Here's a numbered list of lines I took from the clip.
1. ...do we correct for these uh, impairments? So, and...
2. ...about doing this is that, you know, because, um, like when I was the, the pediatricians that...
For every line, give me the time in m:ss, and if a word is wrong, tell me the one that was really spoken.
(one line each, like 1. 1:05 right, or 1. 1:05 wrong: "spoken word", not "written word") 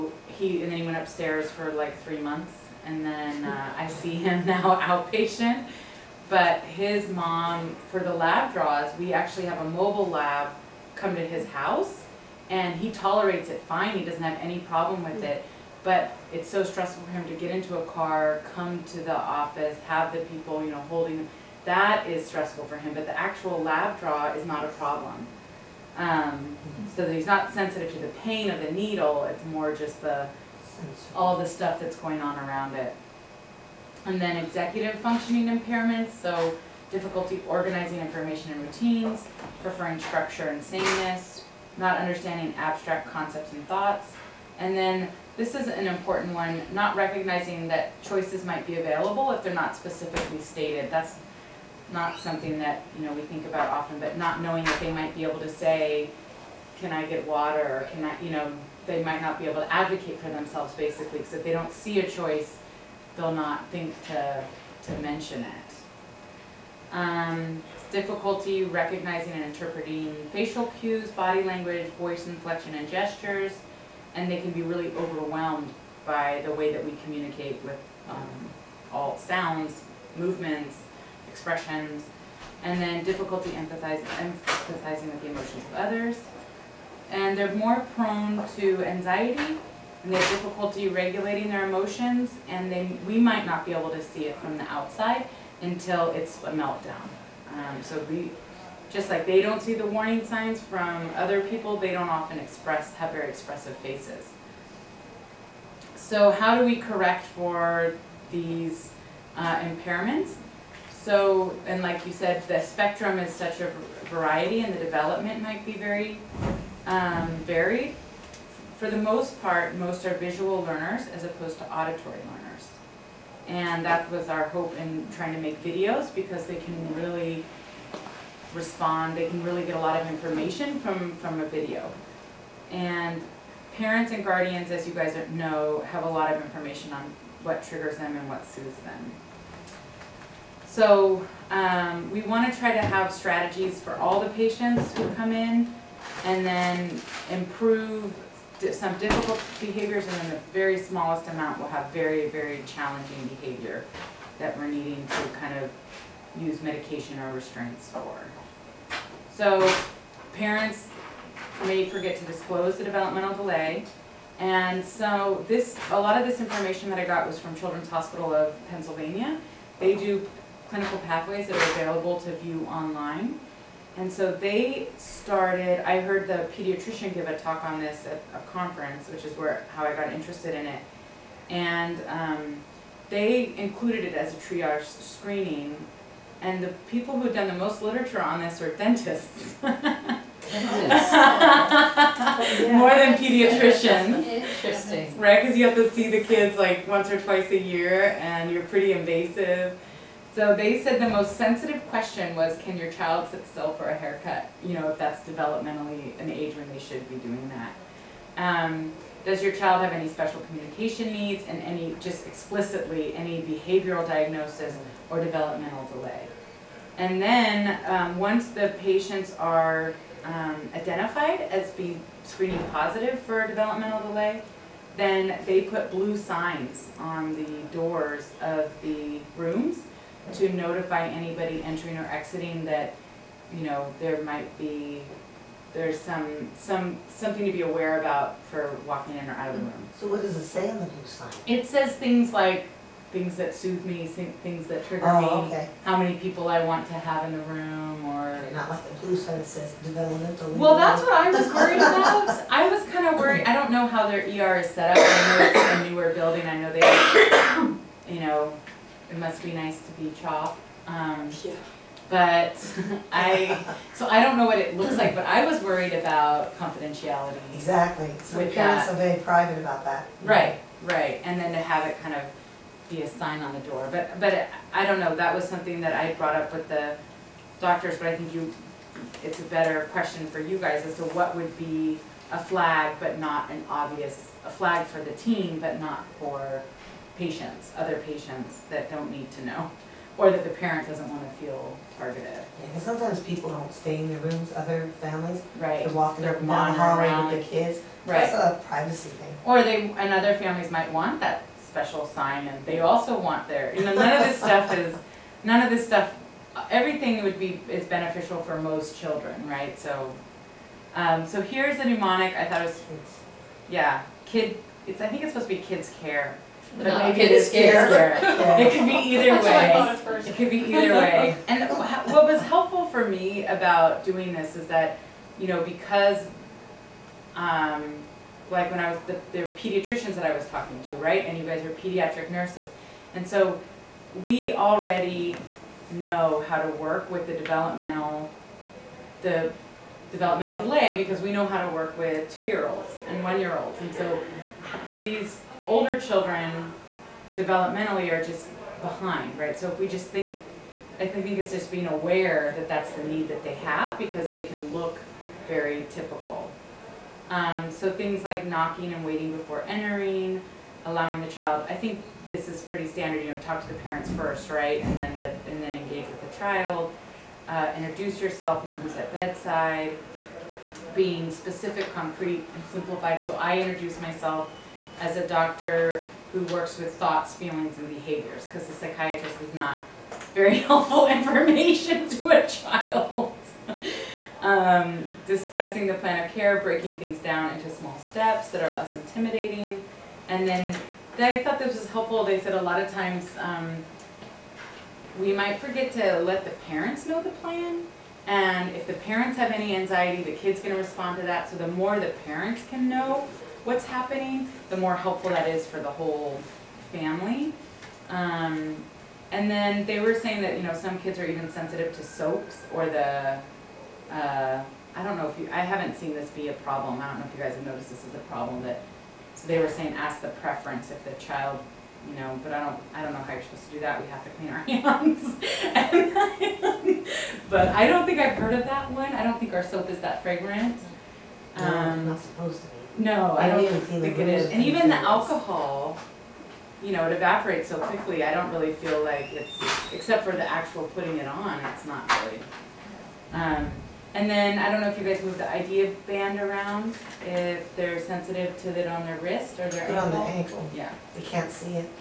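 1. 1:46 right
2. 5:23 right.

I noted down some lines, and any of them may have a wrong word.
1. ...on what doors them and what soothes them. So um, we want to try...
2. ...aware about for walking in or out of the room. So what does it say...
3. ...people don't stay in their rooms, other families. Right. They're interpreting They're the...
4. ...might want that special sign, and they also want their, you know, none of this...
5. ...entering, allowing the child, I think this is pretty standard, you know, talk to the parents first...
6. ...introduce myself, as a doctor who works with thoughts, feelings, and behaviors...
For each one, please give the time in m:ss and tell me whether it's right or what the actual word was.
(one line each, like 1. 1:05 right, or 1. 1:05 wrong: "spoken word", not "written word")
1. 2:16 wrong: "triggers", not "doors"
2. 3:57 right
3. 4:53 wrong: "walking", not "interpreting"
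4. 5:00 right
5. 5:59 right
6. 6:13 right.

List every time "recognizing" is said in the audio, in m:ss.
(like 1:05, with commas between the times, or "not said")
0:46, 1:08.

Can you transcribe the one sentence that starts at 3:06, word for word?
And the people who had done the most literature on this are dentists.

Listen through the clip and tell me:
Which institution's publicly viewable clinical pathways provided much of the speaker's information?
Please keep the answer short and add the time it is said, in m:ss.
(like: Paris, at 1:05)
Children's Hospital of Pennsylvania, at 2:47.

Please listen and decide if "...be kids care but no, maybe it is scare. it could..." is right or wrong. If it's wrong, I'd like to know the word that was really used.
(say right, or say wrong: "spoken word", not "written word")
right.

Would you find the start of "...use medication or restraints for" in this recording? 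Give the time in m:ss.
2:36.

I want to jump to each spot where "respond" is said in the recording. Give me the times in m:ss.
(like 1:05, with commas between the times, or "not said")
2:08, 6:40.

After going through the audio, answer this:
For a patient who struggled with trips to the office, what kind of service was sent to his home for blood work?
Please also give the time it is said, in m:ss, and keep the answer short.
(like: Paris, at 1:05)
mobile lab, at 0:09.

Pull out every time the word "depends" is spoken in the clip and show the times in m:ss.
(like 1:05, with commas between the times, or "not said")
not said.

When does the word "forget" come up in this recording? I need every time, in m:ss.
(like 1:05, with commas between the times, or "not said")
2:41, 6:35.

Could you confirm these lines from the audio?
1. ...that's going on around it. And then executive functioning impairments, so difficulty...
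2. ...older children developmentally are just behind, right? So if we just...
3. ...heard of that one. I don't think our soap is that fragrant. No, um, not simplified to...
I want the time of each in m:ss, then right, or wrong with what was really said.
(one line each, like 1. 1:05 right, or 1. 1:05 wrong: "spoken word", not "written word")
1. 0:31 right
2. 5:45 right
3. 7:08 wrong: "supposed", not "simplified".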